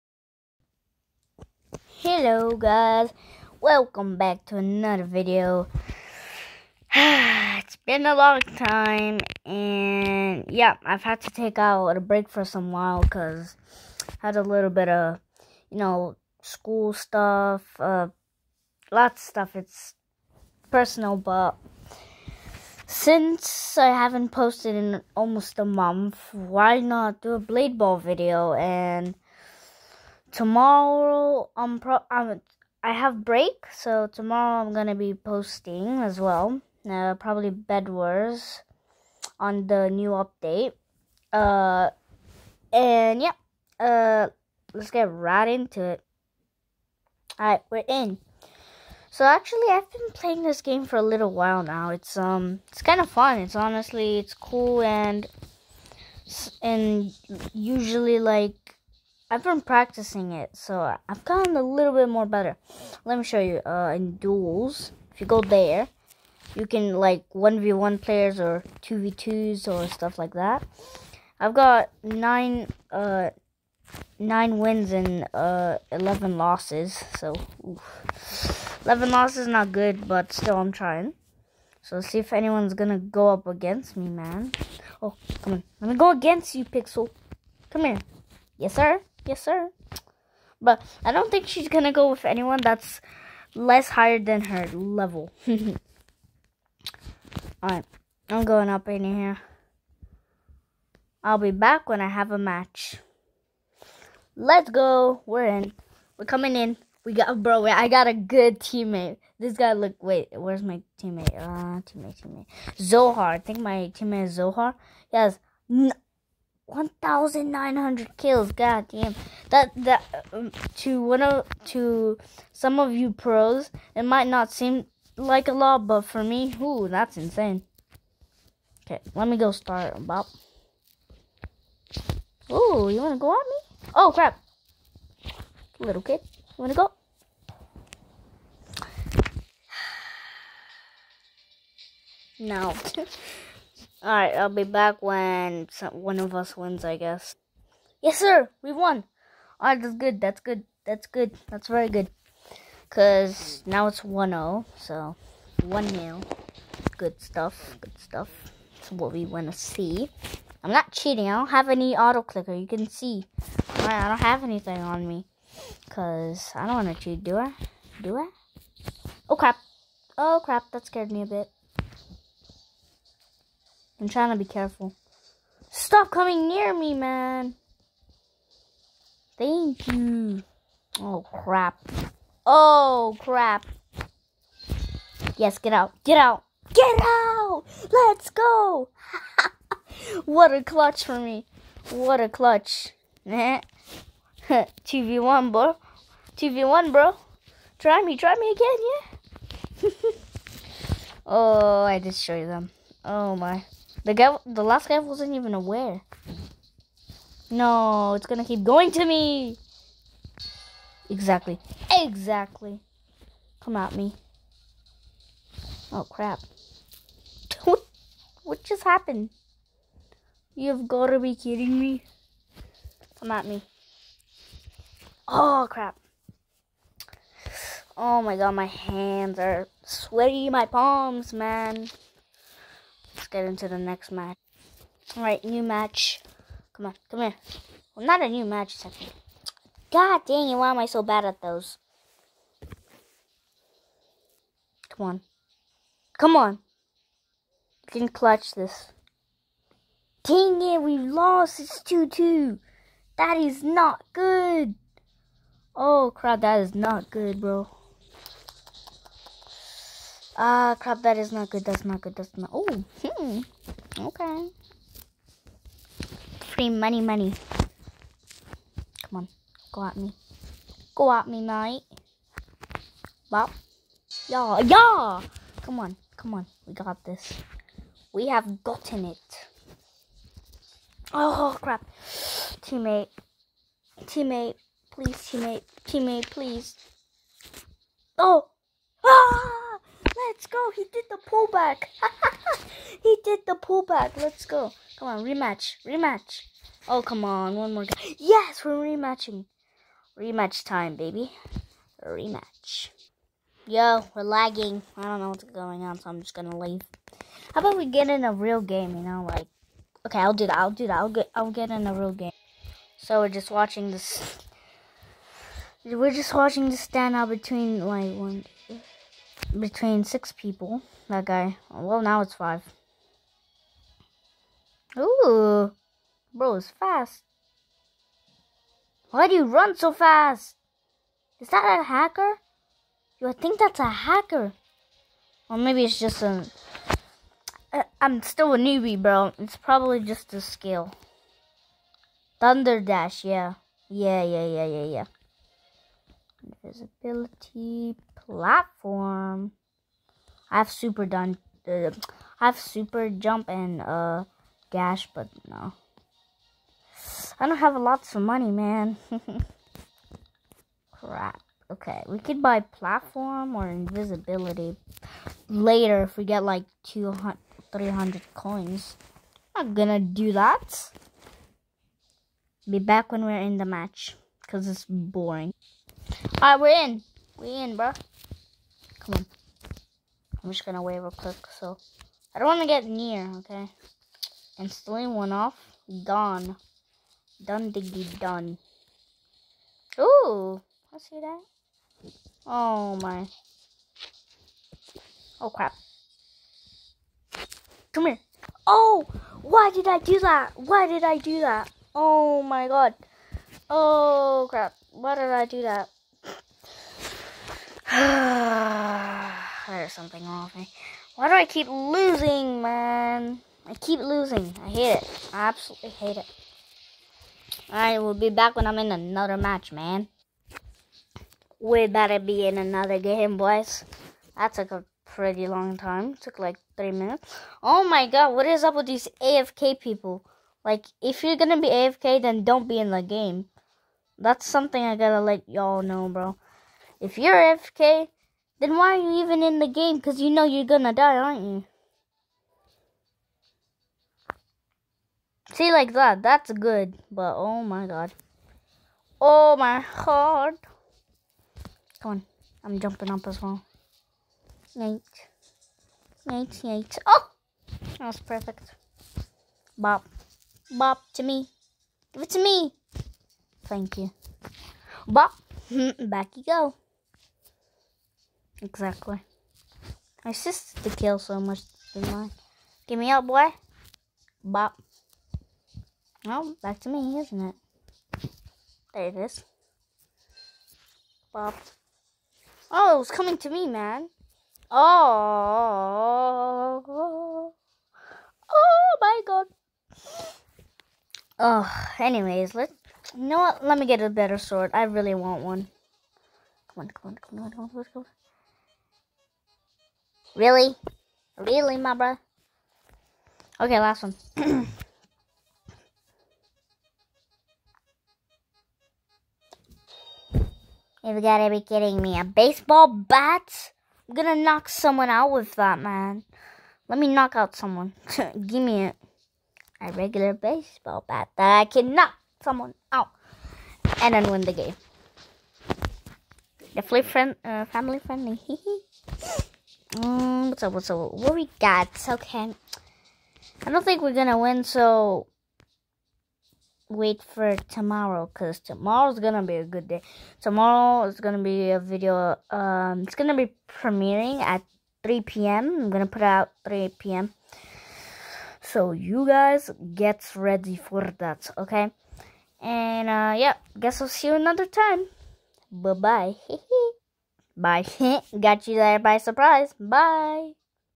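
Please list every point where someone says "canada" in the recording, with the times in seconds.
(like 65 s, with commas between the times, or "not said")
not said.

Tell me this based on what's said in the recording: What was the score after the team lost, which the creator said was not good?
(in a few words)
2-2.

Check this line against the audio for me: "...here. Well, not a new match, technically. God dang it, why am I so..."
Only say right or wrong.
right.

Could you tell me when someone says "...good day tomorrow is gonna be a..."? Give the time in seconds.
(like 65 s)
539 s.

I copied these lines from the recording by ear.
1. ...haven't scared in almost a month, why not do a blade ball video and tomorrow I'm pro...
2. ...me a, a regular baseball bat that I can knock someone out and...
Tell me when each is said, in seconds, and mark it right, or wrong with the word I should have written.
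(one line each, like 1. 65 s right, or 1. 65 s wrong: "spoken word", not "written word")
1. 23 s wrong: "posted", not "scared"
2. 518 s right.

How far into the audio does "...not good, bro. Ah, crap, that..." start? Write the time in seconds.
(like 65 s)
256 s.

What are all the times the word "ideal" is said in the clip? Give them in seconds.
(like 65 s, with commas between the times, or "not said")
not said.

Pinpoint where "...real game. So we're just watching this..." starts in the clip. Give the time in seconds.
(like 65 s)
311 s.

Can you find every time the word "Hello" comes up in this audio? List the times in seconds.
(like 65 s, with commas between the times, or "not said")
2 s.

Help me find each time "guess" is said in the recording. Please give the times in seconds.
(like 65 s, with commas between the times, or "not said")
146 s, 553 s.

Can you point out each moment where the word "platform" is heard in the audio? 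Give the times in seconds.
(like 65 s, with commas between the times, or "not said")
348 s, 362 s.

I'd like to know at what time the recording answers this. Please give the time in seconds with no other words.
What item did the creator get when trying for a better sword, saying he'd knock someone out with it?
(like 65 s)
512 s.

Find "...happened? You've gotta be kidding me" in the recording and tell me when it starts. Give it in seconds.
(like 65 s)
218 s.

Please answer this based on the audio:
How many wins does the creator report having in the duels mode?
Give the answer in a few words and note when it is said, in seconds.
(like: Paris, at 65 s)
9, at 74 s.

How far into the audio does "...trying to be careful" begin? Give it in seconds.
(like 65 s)
174 s.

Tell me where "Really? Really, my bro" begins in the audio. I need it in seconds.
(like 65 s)
500 s.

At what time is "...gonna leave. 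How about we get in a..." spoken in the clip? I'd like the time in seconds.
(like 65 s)
306 s.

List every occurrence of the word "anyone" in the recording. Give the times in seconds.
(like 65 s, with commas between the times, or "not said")
82 s, 92 s.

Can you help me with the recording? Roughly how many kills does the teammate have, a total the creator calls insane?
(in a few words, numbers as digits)
1,900.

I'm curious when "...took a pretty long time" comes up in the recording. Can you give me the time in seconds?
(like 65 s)
424 s.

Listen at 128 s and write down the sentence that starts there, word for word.
Okay, let me go start about.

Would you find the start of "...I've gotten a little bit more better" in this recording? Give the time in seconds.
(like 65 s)
61 s.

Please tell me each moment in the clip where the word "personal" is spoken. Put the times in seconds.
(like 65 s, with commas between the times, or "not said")
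20 s.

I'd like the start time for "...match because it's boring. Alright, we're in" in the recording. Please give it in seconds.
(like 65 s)
373 s.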